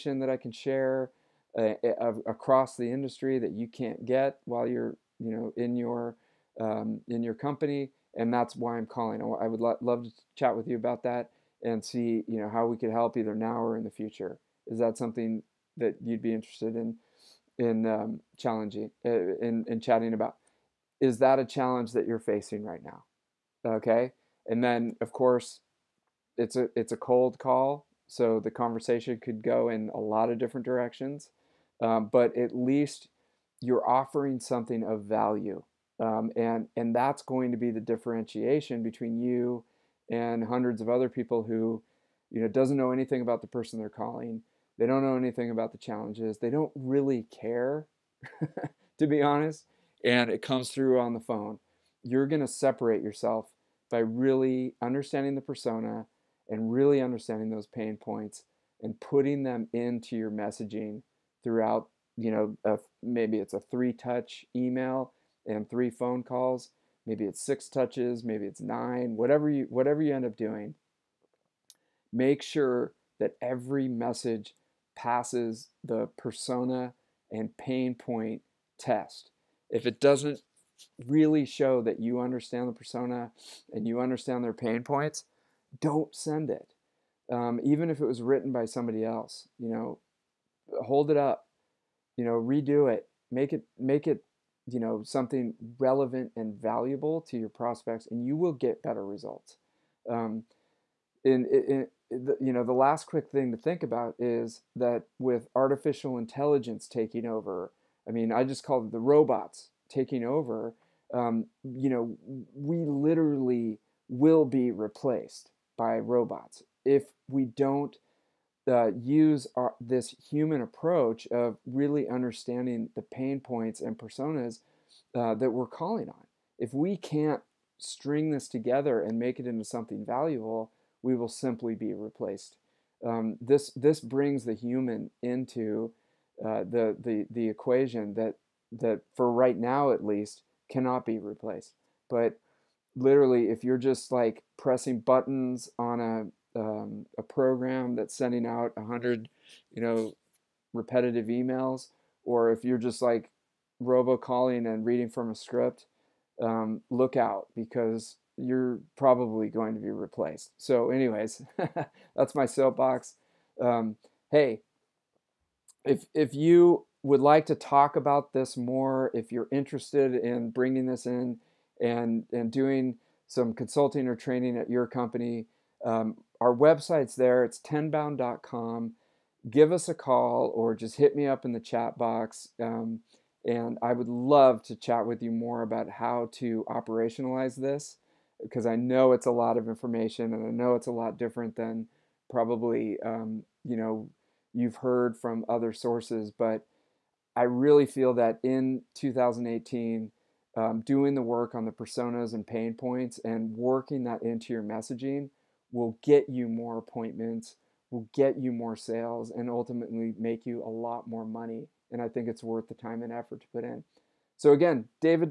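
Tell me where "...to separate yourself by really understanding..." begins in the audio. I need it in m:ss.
0:52.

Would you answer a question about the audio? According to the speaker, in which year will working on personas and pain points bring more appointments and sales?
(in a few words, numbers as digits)
2018.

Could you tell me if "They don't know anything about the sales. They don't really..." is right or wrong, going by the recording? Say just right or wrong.
wrong.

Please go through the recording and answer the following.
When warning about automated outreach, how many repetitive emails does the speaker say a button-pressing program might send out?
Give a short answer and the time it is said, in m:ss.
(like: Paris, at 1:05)
100, at 2:28.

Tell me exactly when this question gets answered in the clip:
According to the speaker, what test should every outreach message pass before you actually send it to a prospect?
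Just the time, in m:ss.
1:16.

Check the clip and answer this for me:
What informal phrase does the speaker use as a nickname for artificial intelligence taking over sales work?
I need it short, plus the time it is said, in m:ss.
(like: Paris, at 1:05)
the robots taking over, at 1:48.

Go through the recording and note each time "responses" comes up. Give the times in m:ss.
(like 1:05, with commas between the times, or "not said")
not said.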